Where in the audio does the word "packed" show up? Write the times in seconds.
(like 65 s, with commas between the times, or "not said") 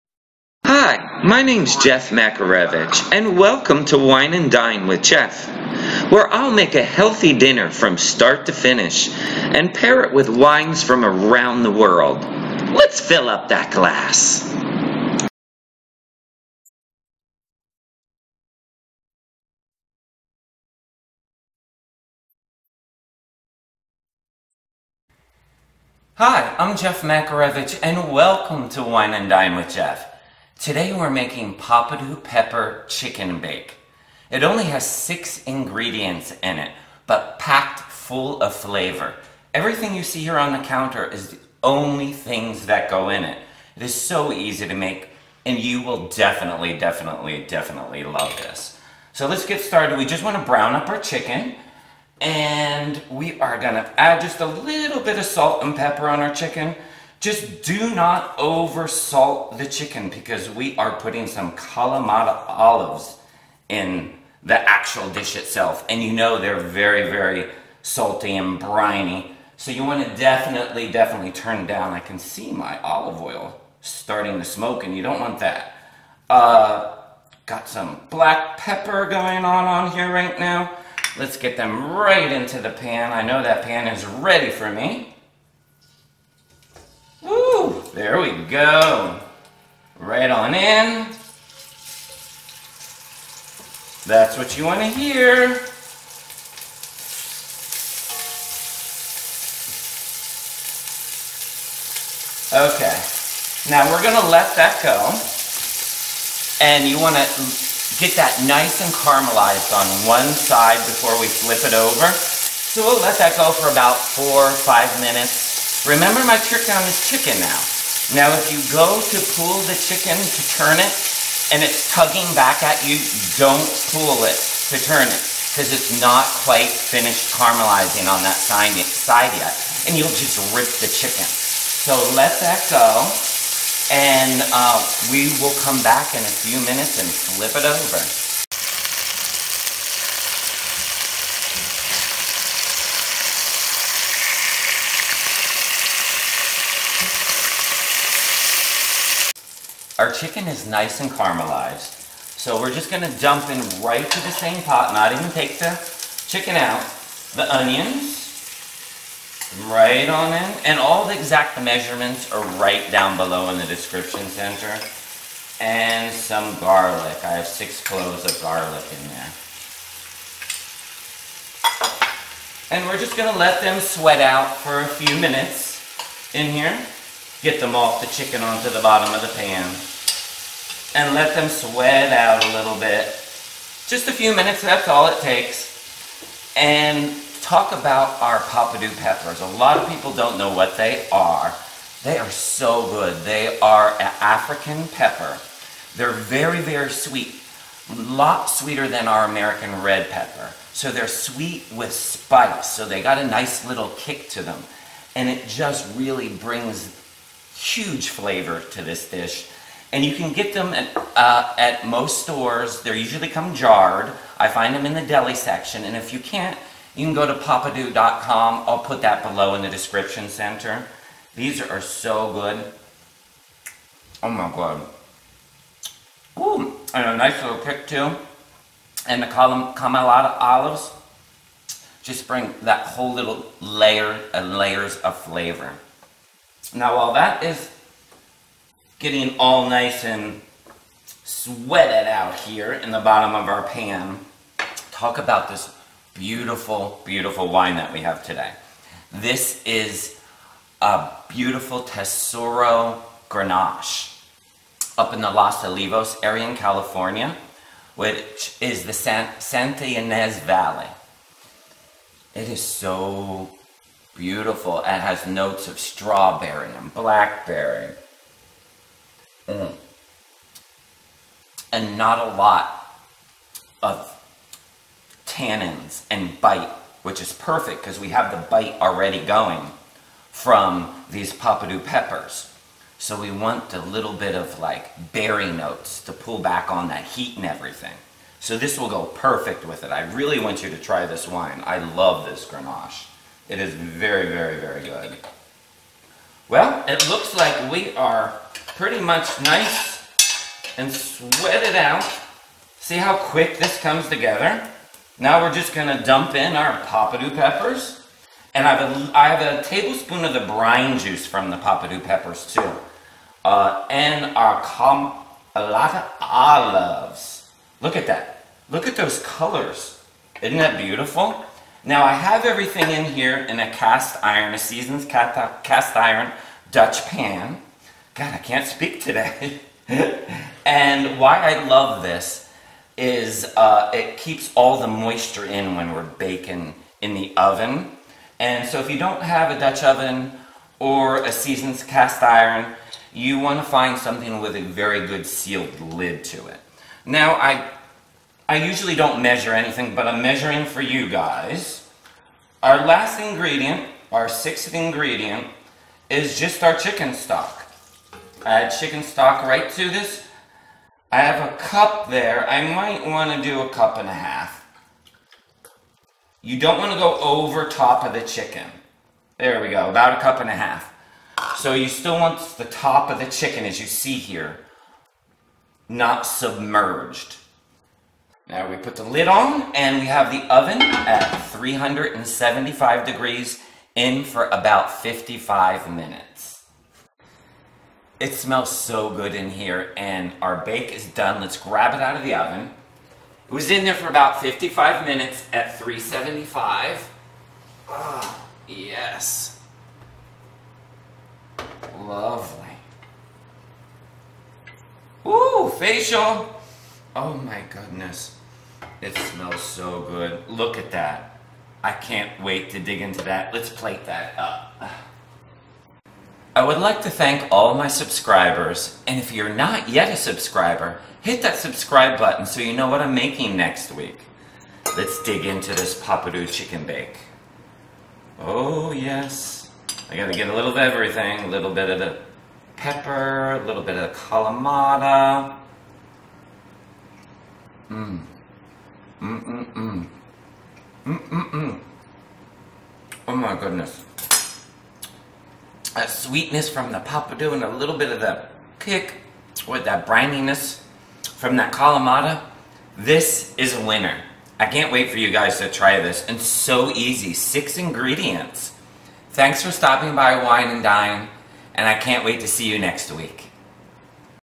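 37 s.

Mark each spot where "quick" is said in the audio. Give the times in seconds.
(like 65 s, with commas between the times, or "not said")
303 s.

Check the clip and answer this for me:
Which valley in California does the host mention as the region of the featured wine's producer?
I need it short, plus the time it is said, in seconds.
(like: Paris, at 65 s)
Santa Ynez Valley, at 259 s.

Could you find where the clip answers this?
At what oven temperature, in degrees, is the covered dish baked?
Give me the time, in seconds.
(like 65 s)
381 s.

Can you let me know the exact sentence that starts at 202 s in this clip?
So they got a nice little kick to them.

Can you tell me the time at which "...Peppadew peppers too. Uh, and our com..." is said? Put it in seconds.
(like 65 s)
311 s.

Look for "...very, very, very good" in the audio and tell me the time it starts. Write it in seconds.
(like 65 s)
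293 s.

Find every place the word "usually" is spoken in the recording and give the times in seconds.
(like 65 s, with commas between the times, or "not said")
212 s, 348 s.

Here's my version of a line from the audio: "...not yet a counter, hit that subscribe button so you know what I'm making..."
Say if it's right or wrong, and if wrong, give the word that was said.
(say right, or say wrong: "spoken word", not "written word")
wrong: "subscriber", not "counter".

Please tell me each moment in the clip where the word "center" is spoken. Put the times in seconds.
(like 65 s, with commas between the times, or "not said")
164 s, 220 s.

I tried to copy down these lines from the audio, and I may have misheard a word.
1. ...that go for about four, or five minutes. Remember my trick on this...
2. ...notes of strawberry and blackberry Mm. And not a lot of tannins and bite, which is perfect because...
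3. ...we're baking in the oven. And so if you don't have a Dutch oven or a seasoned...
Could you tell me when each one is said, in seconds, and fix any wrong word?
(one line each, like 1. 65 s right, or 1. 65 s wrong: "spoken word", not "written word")
1. 113 s right
2. 265 s right
3. 335 s right.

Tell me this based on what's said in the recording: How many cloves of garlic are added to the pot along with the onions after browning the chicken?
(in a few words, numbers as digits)
6.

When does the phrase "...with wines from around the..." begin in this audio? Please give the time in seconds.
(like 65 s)
10 s.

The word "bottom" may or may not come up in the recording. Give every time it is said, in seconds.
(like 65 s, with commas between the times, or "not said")
178 s, 242 s.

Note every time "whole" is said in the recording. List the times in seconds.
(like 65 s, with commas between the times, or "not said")
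232 s.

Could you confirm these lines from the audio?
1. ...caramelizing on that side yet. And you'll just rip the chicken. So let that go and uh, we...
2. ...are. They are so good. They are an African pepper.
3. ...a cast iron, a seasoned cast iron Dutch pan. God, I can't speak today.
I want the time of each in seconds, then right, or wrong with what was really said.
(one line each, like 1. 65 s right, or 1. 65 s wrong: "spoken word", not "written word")
1. 127 s right
2. 191 s right
3. 323 s right.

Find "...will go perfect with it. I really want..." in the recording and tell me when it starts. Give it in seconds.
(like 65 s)
288 s.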